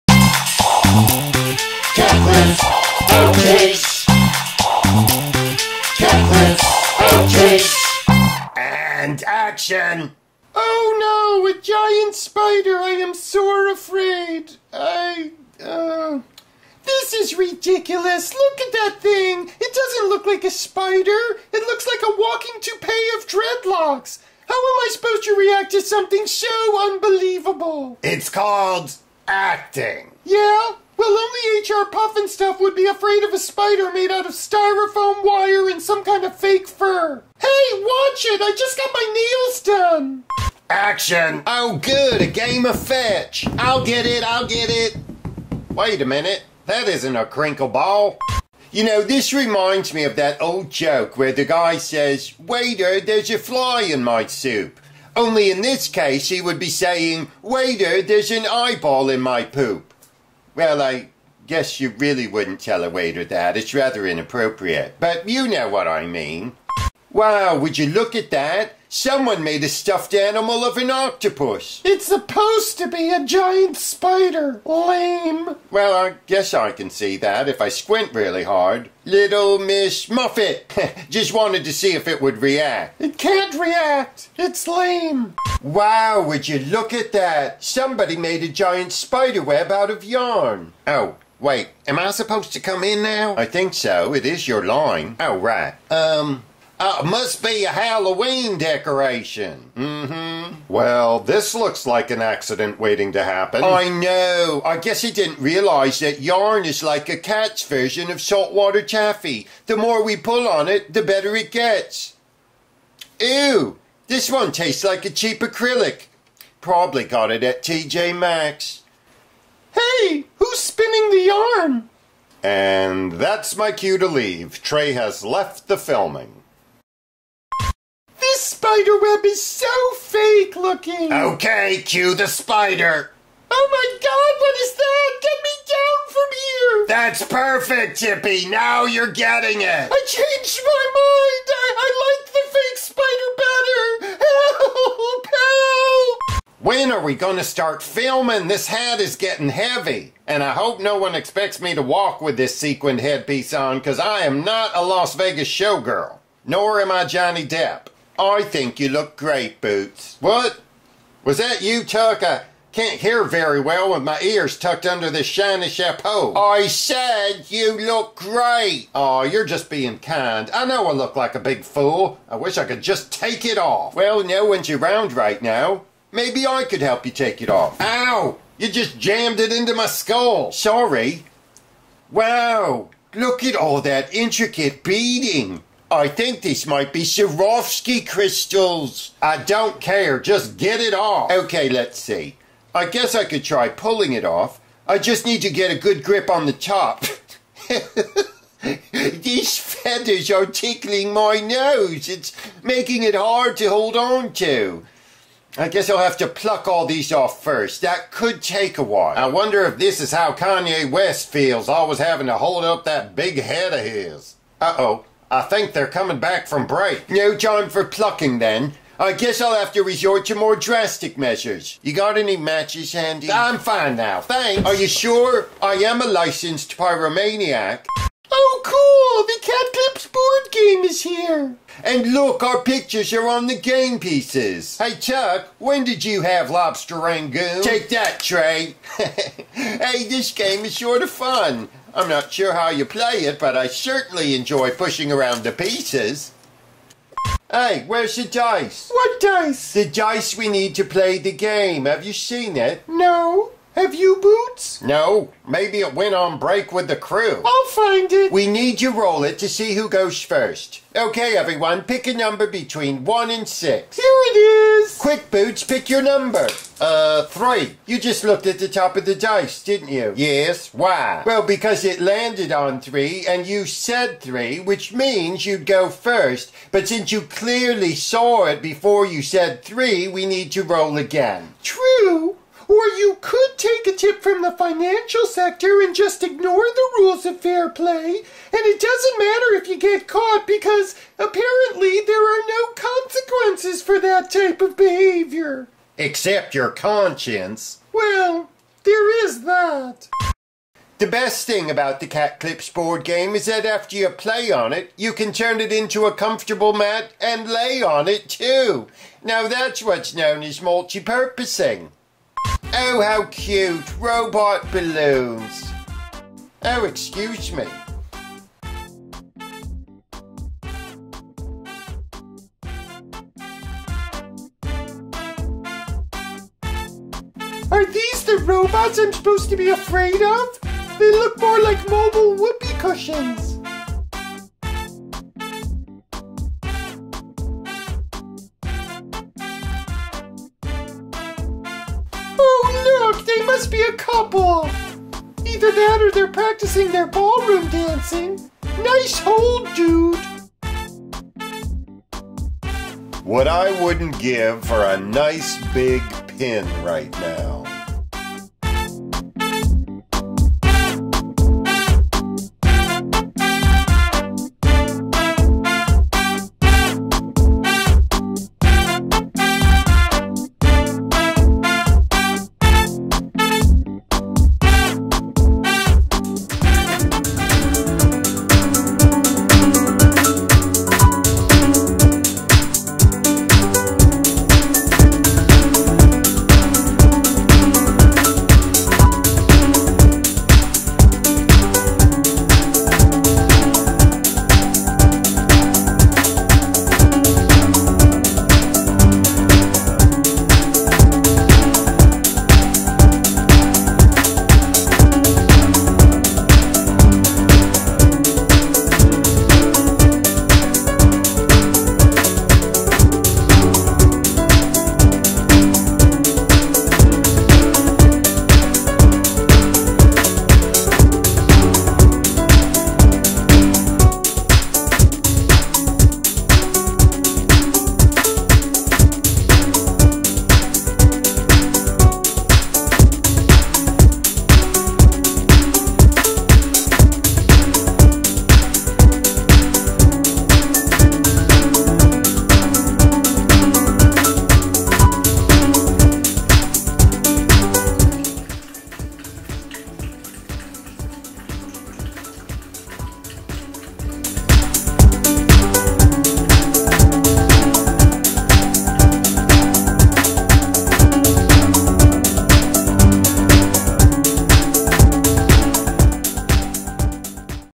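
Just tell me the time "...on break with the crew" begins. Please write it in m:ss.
4:16.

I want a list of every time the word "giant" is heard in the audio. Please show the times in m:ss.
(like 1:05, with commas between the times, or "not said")
0:11, 1:13, 1:28.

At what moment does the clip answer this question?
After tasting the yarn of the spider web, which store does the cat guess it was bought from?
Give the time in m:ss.
1:57.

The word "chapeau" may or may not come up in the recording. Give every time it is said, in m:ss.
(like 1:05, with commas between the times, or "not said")
2:45.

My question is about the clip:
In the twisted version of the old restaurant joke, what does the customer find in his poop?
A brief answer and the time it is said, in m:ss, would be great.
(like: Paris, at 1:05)
An eyeball, at 0:58.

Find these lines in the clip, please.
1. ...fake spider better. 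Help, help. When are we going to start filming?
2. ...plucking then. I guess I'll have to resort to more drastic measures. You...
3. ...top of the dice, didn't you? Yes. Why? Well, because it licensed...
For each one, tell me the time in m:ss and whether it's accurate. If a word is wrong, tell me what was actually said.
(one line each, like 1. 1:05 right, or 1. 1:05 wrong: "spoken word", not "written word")
1. 2:22 right
2. 3:37 right
3. 4:28 wrong: "landed", not "licensed".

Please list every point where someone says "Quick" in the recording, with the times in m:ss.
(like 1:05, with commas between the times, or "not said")
4:25.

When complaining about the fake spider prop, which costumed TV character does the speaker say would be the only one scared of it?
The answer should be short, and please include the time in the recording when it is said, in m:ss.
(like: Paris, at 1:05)
H.R. Pufnstuf, at 0:31.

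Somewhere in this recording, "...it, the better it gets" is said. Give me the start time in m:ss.
1:50.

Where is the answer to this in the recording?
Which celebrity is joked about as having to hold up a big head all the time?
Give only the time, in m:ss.
3:30.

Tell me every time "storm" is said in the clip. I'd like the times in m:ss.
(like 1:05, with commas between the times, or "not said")
not said.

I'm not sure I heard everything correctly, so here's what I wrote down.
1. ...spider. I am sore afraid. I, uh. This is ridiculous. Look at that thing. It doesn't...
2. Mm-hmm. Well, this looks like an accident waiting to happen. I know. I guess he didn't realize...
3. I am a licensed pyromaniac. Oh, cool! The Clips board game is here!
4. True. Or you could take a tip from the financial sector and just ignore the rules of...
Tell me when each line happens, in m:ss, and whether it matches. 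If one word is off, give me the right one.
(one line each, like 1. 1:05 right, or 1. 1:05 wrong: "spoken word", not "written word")
1. 0:12 right
2. 1:39 right
3. 3:45 right
4. 4:41 right.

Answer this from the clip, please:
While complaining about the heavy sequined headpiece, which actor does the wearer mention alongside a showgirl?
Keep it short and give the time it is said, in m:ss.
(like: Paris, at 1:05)
Johnny Depp, at 2:37.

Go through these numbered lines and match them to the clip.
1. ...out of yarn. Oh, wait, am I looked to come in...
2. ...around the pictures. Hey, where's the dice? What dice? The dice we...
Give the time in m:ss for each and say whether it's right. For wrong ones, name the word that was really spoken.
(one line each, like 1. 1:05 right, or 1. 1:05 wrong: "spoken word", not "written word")
1. 1:29 wrong: "supposed", not "looked"
2. 4:05 wrong: "pieces", not "pictures".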